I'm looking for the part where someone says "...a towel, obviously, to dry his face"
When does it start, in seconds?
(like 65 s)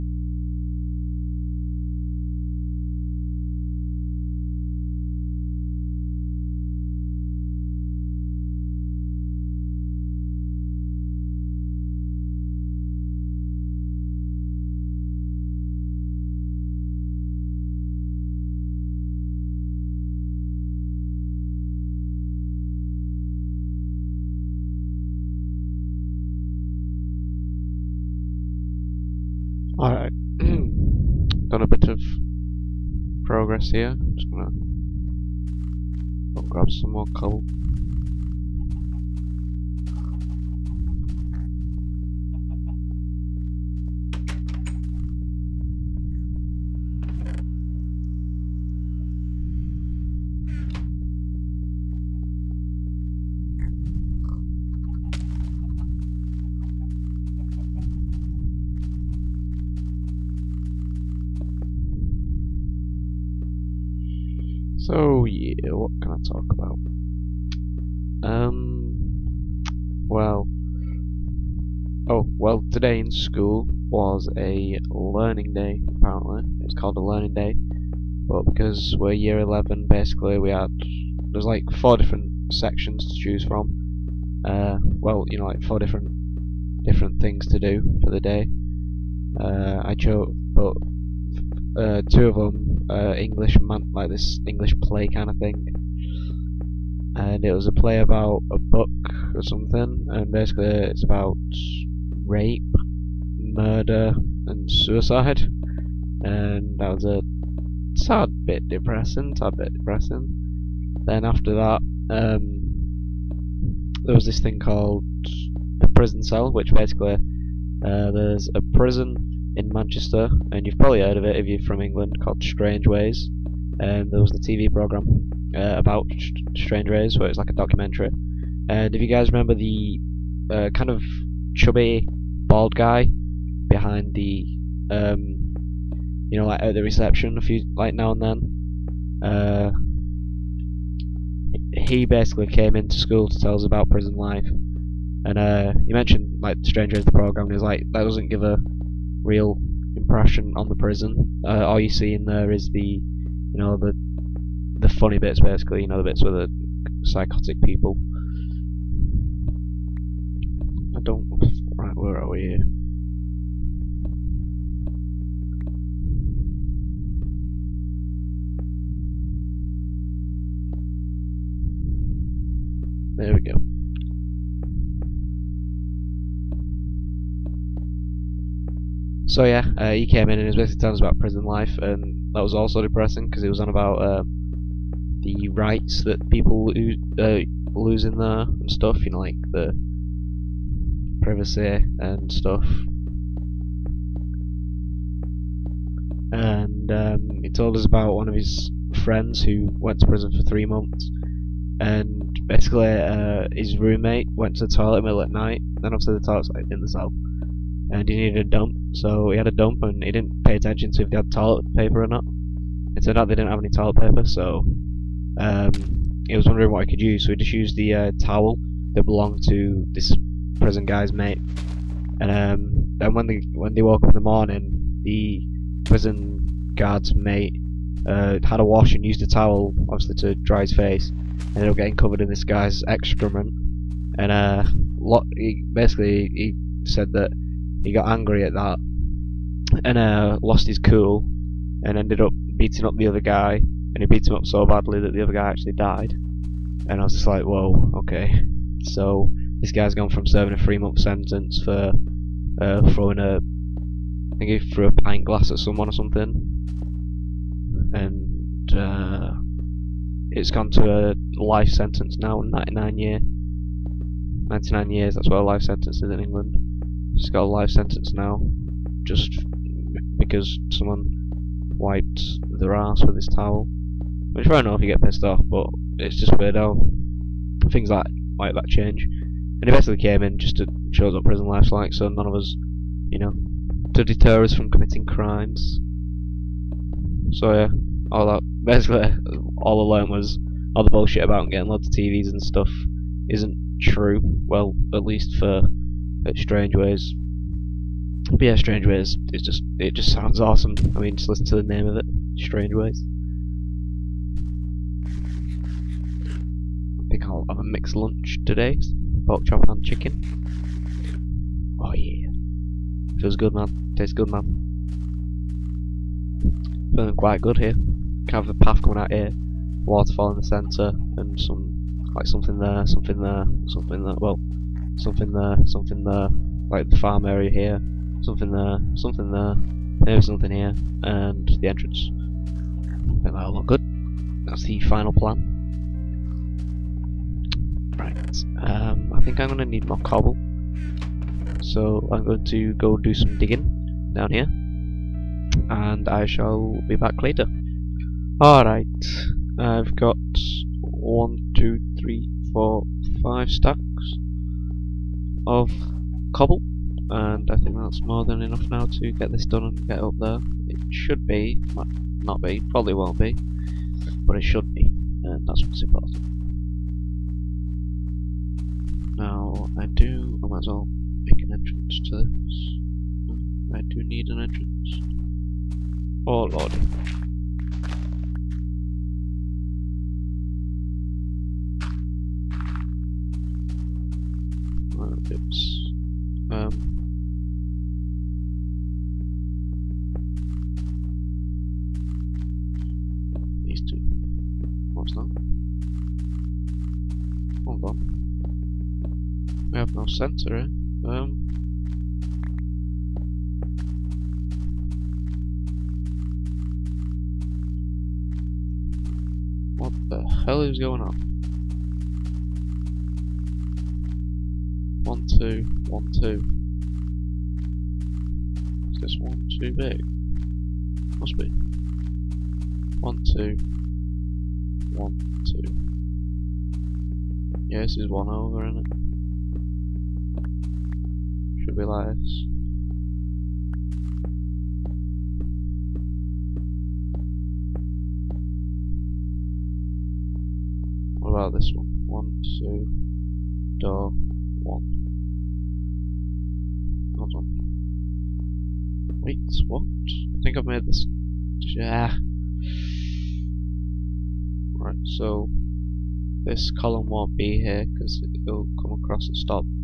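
229 s.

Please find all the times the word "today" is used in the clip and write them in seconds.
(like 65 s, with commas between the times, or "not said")
72 s, 308 s.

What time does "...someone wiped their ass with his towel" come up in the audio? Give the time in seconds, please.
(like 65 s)
270 s.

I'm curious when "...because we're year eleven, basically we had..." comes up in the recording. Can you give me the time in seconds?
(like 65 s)
78 s.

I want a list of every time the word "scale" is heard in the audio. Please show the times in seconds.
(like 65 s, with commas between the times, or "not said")
not said.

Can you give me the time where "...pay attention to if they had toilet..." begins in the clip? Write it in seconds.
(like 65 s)
210 s.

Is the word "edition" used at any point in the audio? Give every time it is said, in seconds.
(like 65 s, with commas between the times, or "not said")
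not said.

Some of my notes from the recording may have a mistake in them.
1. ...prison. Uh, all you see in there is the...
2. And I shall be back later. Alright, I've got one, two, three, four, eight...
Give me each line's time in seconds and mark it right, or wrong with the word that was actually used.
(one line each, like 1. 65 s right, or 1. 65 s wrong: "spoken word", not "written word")
1. 150 s right
2. 345 s wrong: "five", not "eight".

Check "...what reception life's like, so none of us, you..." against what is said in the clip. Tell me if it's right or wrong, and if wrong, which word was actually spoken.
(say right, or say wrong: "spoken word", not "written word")
wrong: "prison", not "reception".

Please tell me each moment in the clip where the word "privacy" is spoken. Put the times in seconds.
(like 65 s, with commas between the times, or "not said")
191 s.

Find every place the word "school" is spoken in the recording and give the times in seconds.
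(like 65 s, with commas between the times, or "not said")
73 s, 142 s.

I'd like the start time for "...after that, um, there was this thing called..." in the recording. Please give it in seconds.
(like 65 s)
111 s.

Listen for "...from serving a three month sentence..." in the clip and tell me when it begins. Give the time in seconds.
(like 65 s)
250 s.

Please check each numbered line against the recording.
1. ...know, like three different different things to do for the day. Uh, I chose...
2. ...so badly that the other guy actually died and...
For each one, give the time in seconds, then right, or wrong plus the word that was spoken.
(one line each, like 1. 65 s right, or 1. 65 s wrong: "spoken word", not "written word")
1. 85 s wrong: "four", not "three"
2. 244 s right.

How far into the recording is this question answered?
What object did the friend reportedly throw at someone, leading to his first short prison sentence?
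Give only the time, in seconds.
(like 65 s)
254 s.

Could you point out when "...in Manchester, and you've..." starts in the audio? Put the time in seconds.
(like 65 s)
119 s.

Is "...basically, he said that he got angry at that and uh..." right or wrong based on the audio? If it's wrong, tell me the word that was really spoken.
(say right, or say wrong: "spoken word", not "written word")
right.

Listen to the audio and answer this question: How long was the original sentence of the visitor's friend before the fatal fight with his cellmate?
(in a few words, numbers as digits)
3 months.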